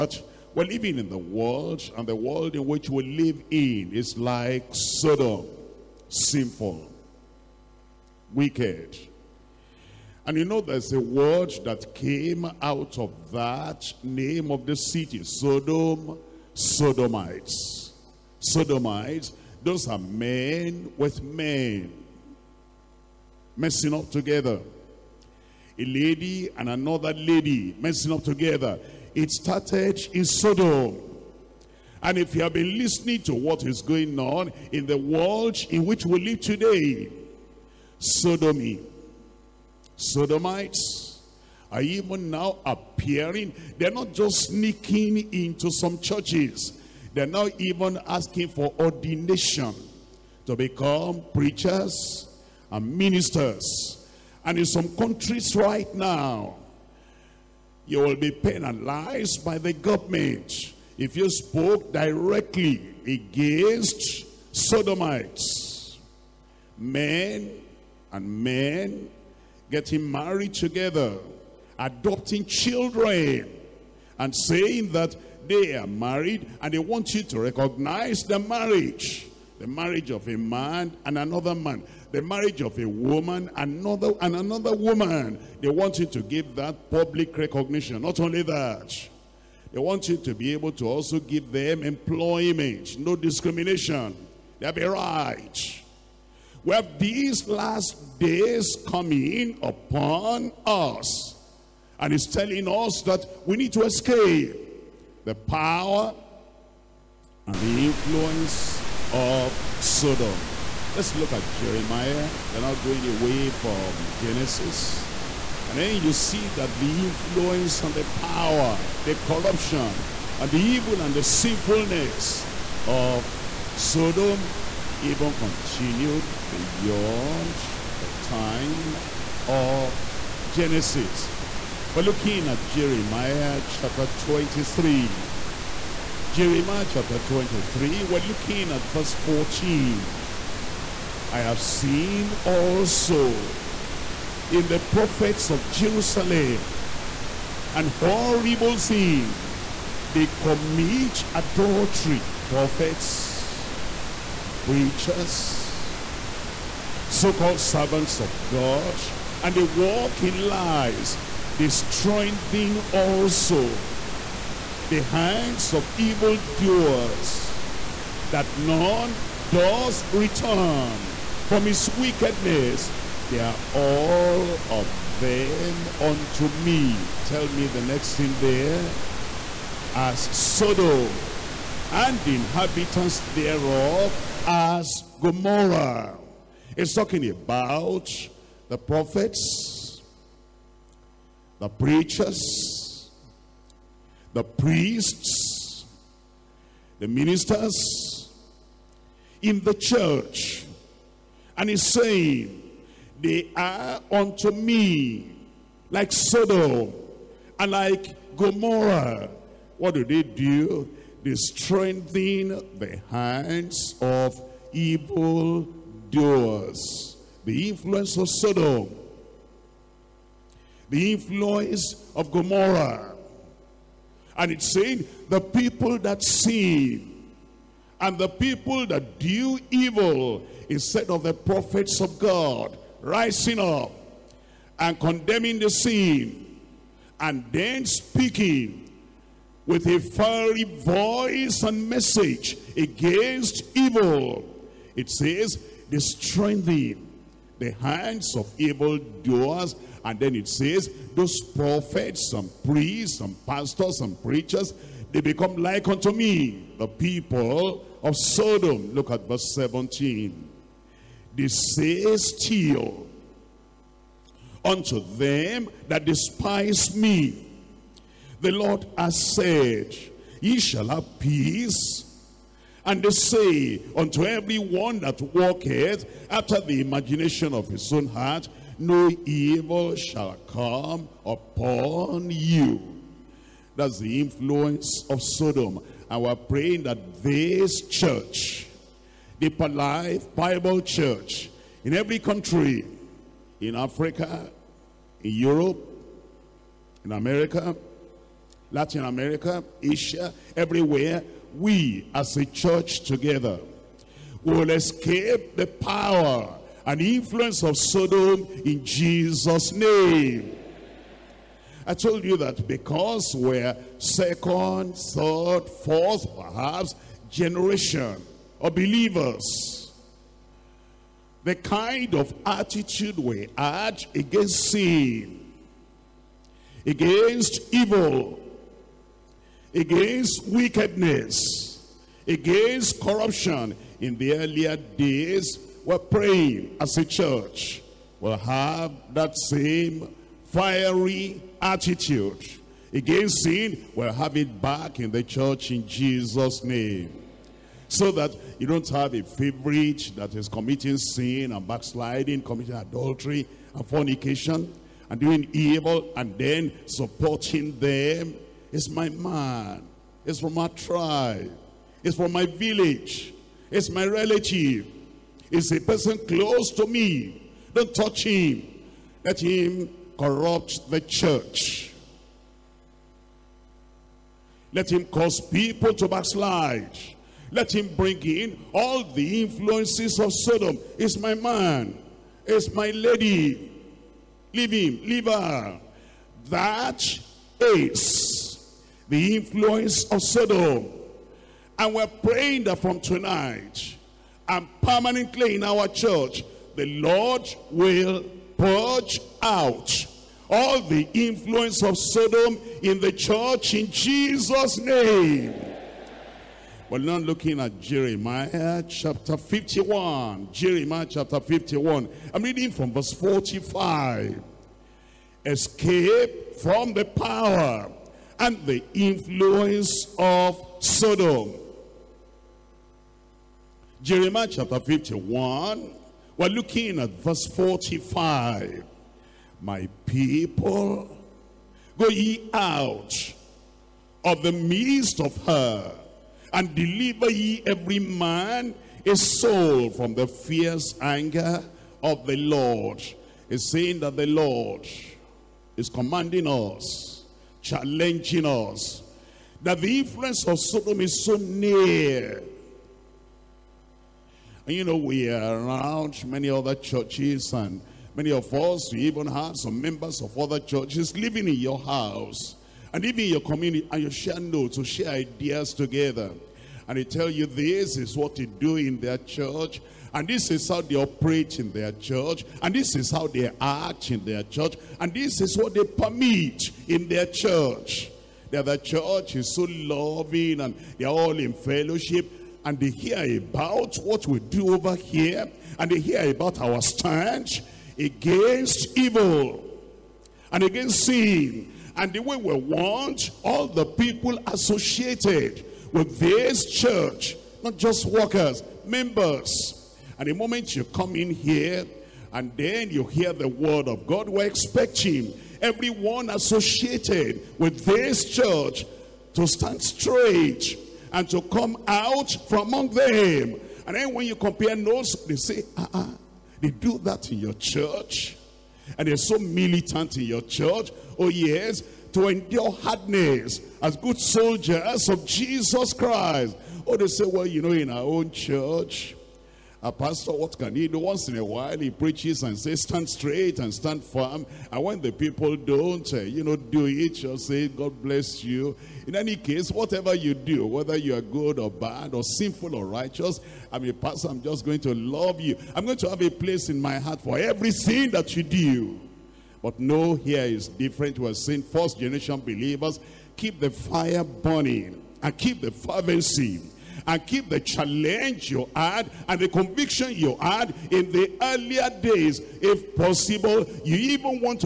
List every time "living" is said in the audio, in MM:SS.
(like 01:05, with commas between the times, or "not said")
00:00, 07:41.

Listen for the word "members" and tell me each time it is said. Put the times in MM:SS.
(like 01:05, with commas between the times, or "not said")
07:39, 08:18.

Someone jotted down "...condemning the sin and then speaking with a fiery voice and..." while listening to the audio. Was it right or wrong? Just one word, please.
right.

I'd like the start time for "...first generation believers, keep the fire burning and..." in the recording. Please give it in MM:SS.
09:11.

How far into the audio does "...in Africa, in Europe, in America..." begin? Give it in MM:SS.
04:53.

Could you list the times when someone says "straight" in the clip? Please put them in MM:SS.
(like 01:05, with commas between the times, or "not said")
08:29, 08:53.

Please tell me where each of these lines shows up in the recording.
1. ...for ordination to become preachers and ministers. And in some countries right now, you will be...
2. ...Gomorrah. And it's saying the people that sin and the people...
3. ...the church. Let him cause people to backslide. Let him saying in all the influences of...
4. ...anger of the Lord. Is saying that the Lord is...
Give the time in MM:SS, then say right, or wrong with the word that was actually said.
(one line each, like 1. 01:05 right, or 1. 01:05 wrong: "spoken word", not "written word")
1. 00:48 right
2. 03:42 right
3. 06:10 wrong: "bring", not "saying"
4. 07:21 right.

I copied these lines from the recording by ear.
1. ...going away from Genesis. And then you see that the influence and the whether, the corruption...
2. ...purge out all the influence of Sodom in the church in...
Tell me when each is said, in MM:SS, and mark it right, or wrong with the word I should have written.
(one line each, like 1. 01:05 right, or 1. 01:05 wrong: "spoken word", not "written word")
1. 01:52 wrong: "power", not "whether"
2. 06:38 right.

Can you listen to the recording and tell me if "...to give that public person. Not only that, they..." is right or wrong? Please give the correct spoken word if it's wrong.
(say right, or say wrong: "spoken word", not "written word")
wrong: "recognition", not "person".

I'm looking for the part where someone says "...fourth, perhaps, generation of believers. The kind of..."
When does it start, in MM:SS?
05:15.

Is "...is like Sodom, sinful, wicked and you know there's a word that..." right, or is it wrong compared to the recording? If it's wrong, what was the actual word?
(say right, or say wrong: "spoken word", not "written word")
right.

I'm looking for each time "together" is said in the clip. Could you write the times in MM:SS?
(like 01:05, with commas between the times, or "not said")
00:24, 00:28, 01:10, 05:03, 07:45.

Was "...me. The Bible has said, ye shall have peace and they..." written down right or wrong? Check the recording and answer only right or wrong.
wrong.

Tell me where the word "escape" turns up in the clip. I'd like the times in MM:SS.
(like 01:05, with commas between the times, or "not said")
01:43, 05:04, 06:55.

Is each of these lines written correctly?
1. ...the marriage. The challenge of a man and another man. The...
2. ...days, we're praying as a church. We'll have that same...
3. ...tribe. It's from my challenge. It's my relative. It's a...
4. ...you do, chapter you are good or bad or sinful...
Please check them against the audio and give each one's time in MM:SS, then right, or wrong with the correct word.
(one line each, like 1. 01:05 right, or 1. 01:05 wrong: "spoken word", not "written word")
1. 01:18 wrong: "marriage", not "challenge"
2. 05:34 right
3. 06:00 wrong: "village", not "challenge"
4. 09:00 wrong: "whether", not "chapter".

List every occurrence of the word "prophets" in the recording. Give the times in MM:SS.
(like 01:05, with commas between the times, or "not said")
02:24, 02:32, 03:08, 03:51, 04:11.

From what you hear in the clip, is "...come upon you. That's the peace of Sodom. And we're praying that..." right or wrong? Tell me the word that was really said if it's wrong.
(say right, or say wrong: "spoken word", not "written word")
wrong: "influence", not "peace".